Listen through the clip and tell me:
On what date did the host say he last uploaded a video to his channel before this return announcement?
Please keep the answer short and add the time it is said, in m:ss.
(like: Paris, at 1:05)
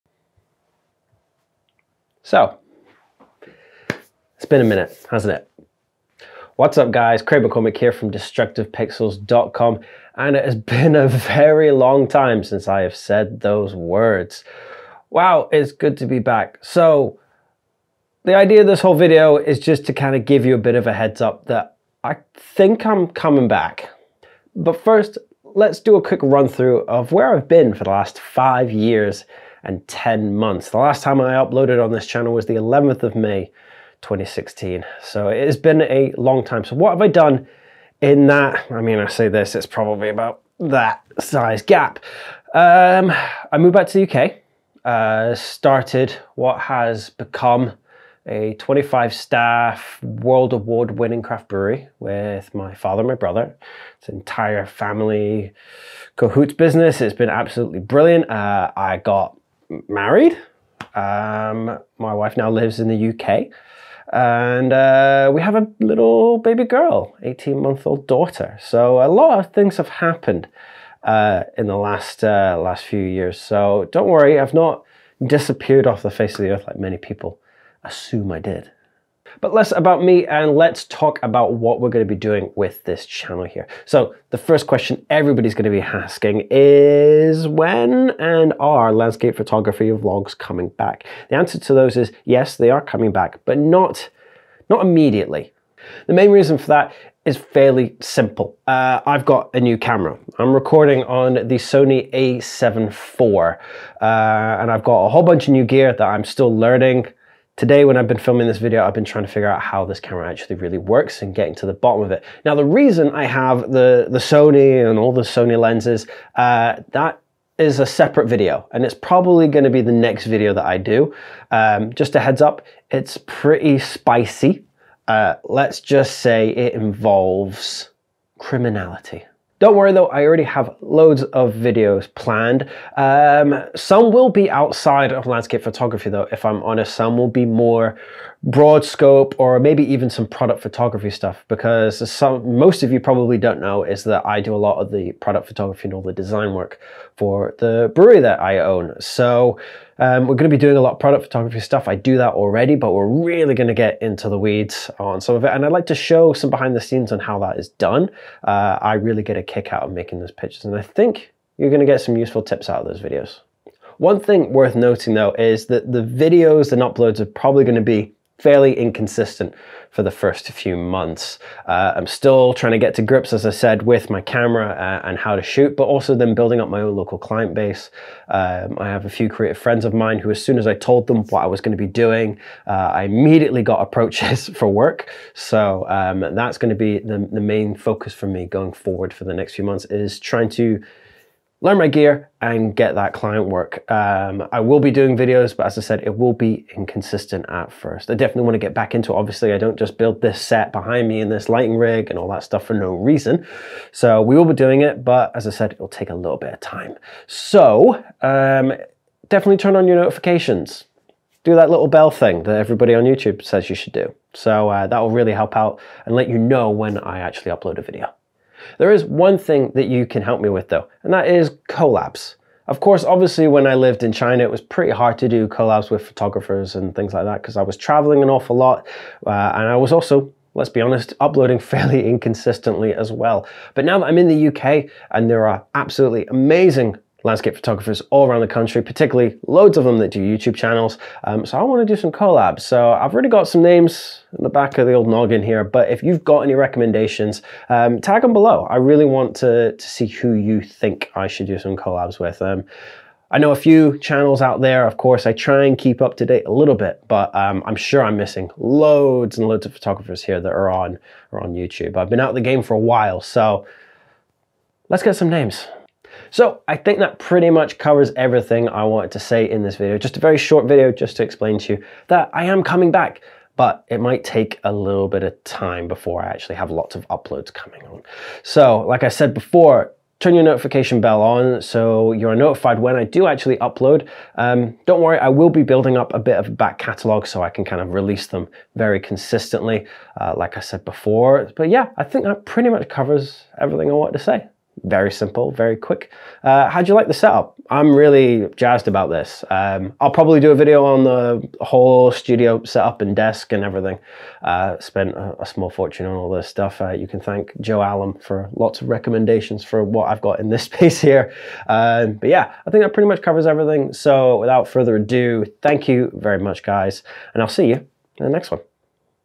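11 May 2016, at 0:32.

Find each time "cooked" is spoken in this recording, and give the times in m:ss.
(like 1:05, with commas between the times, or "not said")
not said.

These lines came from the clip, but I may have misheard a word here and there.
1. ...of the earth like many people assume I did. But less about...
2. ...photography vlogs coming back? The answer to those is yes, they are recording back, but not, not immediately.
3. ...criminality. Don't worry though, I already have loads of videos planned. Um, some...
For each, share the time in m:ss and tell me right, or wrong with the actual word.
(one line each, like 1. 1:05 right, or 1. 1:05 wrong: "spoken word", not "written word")
1. 1:16 right
2. 1:29 wrong: "coming", not "recording"
3. 2:08 right.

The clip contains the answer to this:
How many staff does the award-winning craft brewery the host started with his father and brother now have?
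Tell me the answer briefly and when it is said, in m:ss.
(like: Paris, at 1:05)
25, at 0:48.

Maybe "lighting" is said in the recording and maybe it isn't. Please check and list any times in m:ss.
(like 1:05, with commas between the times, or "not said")
3:21.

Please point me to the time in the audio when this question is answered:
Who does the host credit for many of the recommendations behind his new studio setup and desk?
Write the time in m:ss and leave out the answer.
5:07.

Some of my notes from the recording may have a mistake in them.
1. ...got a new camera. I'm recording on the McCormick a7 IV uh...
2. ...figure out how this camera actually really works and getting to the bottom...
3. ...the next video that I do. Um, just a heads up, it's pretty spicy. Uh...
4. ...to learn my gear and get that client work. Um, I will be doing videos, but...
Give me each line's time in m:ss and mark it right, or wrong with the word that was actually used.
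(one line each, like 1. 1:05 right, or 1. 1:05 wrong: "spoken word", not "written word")
1. 1:39 wrong: "Sony", not "McCormick"
2. 1:49 right
3. 1:59 right
4. 3:10 right.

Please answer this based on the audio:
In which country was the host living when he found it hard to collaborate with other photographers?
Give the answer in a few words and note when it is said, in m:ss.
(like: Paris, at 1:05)
China, at 3:44.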